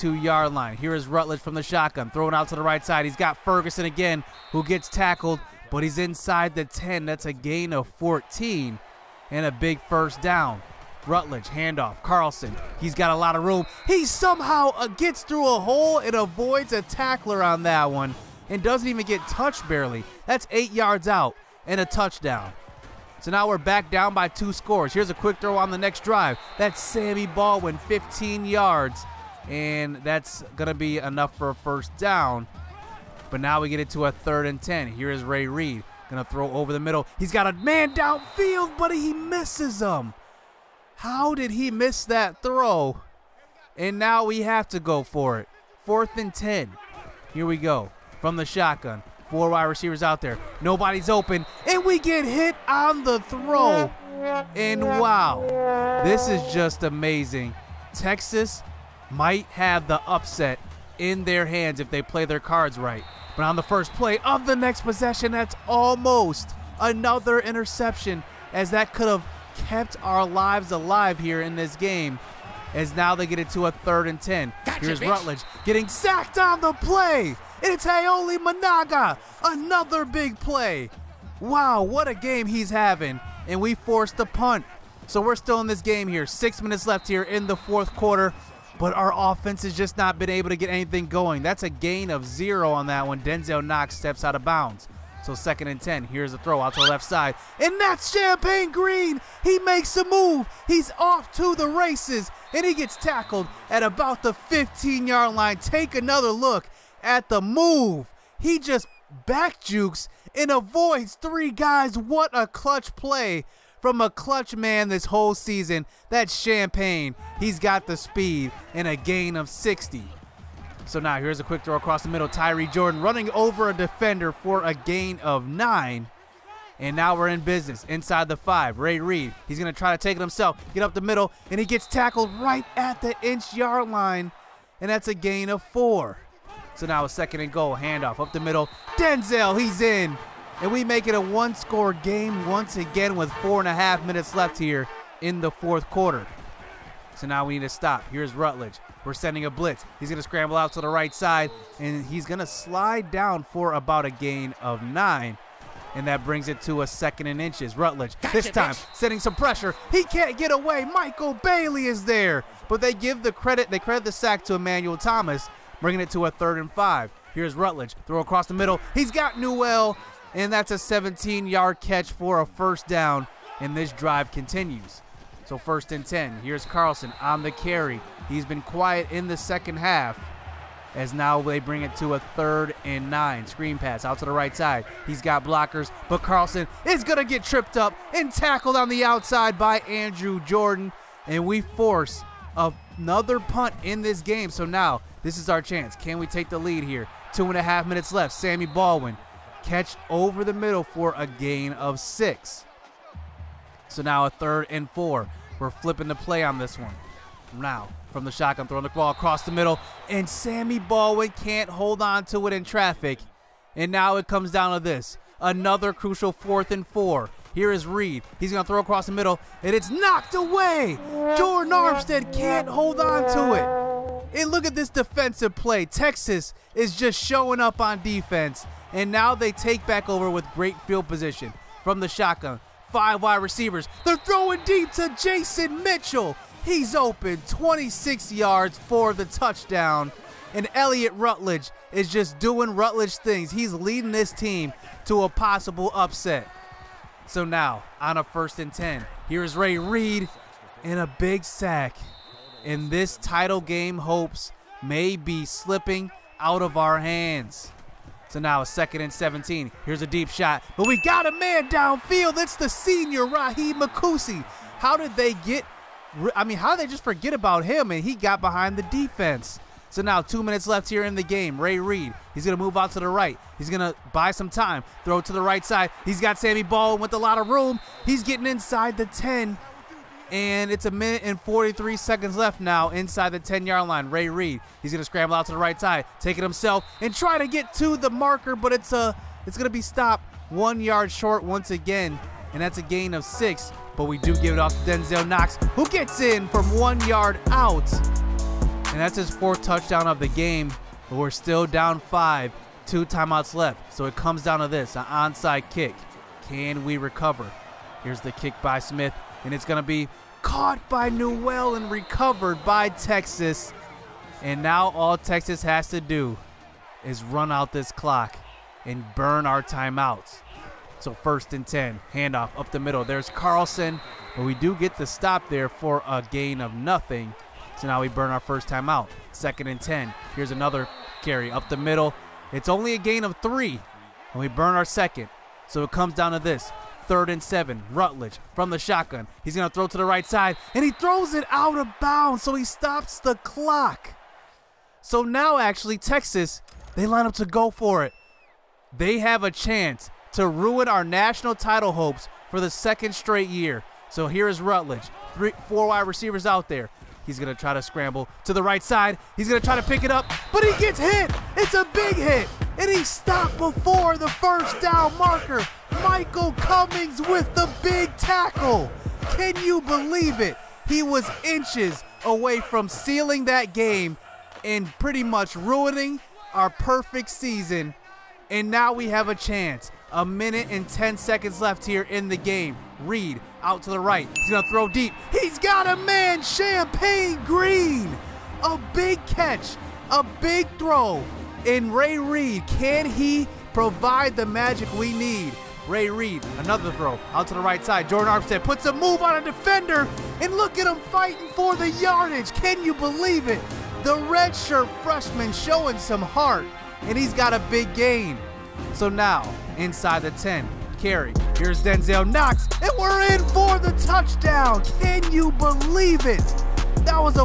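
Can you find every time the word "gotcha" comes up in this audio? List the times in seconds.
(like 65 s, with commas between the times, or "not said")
74 s, 158 s.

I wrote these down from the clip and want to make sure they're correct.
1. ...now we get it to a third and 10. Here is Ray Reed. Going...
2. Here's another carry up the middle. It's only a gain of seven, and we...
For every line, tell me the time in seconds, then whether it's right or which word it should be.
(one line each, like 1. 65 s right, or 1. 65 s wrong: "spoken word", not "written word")
1. 33 s right
2. 330 s wrong: "three", not "seven".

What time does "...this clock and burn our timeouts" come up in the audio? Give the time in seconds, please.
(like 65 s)
317 s.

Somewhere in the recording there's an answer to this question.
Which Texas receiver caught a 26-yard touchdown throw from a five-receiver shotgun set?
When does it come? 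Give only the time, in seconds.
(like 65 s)
235 s.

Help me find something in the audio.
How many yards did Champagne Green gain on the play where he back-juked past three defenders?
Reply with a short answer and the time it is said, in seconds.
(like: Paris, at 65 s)
60, at 118 s.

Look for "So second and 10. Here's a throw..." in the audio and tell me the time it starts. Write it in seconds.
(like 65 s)
95 s.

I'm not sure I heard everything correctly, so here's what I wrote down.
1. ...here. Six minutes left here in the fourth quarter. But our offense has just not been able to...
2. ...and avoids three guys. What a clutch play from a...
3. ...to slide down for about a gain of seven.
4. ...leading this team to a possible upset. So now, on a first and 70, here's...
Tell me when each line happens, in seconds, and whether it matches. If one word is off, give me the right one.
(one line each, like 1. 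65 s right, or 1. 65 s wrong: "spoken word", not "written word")
1. 86 s right
2. 110 s right
3. 152 s wrong: "nine", not "seven"
4. 243 s wrong: "10", not "70".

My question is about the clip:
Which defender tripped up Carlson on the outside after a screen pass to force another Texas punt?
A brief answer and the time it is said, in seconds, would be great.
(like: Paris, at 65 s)
Andrew Jordan, at 189 s.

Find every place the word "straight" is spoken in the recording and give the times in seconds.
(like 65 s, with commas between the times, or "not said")
353 s.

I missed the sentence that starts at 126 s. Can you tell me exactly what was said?
And now we're in business inside the five.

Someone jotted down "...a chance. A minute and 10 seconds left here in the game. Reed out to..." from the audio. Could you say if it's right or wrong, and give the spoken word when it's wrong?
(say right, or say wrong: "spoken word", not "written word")
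right.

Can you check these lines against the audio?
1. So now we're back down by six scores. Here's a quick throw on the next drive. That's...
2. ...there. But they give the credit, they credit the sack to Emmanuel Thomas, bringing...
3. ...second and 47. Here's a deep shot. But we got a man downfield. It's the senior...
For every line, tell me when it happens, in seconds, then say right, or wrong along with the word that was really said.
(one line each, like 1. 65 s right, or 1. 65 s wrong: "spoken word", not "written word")
1. 23 s wrong: "two", not "six"
2. 162 s right
3. 258 s wrong: "17", not "47".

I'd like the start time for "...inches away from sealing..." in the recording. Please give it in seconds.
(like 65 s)
371 s.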